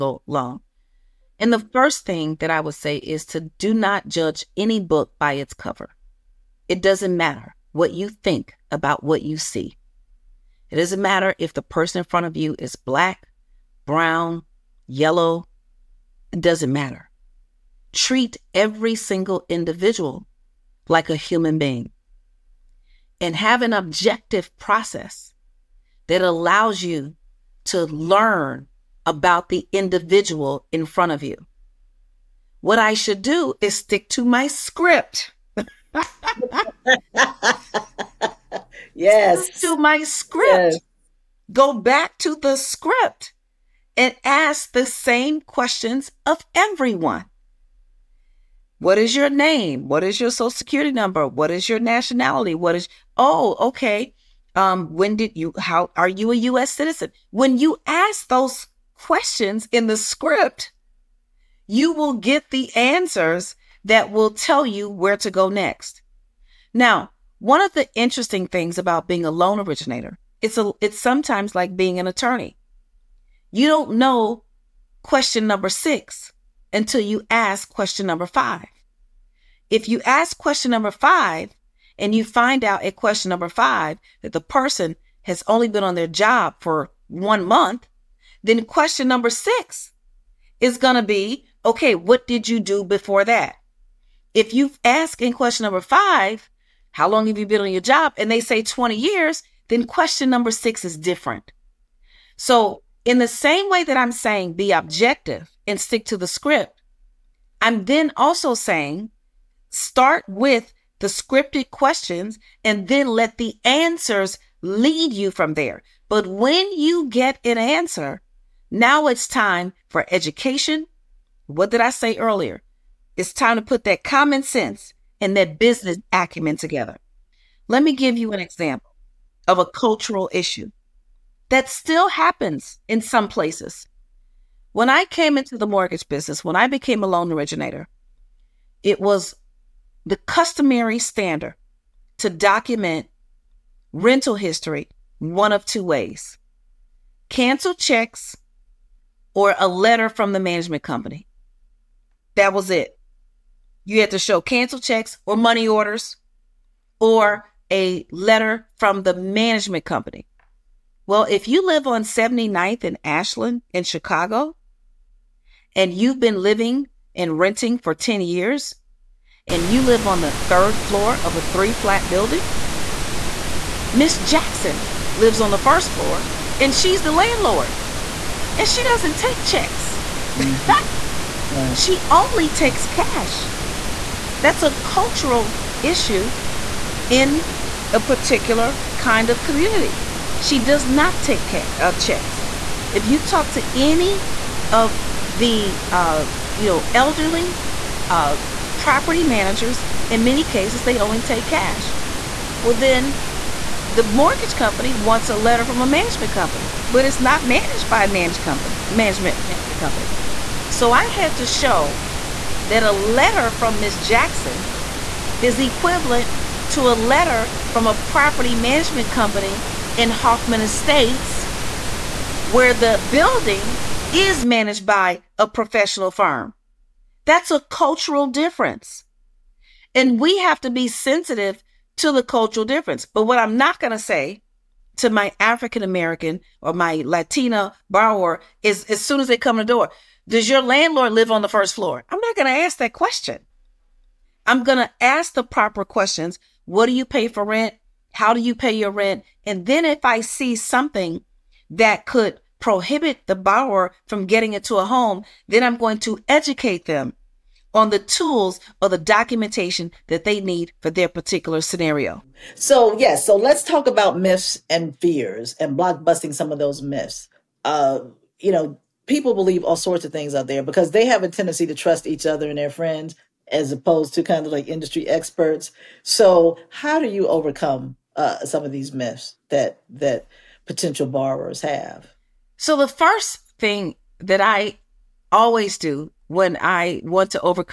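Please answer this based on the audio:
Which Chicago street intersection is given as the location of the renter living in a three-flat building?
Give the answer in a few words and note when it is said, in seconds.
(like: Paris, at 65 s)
79th and Ashland, at 162 s.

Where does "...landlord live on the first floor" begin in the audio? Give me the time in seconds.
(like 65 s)
240 s.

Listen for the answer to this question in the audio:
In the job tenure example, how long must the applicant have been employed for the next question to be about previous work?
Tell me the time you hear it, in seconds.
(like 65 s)
87 s.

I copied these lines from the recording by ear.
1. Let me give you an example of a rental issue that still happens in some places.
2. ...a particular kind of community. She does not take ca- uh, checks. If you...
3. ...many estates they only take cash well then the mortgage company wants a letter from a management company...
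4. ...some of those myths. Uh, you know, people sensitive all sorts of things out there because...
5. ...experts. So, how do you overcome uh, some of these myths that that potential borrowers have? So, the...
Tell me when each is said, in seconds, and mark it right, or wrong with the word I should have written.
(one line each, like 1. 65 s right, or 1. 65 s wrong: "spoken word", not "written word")
1. 127 s wrong: "cultural", not "rental"
2. 187 s right
3. 200 s wrong: "cases", not "estates"
4. 266 s wrong: "believe", not "sensitive"
5. 275 s right.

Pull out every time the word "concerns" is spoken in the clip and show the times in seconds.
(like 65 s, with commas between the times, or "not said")
not said.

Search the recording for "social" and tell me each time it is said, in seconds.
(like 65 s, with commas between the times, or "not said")
50 s.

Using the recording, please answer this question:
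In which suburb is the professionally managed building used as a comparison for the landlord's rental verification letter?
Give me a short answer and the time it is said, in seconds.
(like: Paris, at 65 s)
Hoffman Estates, at 220 s.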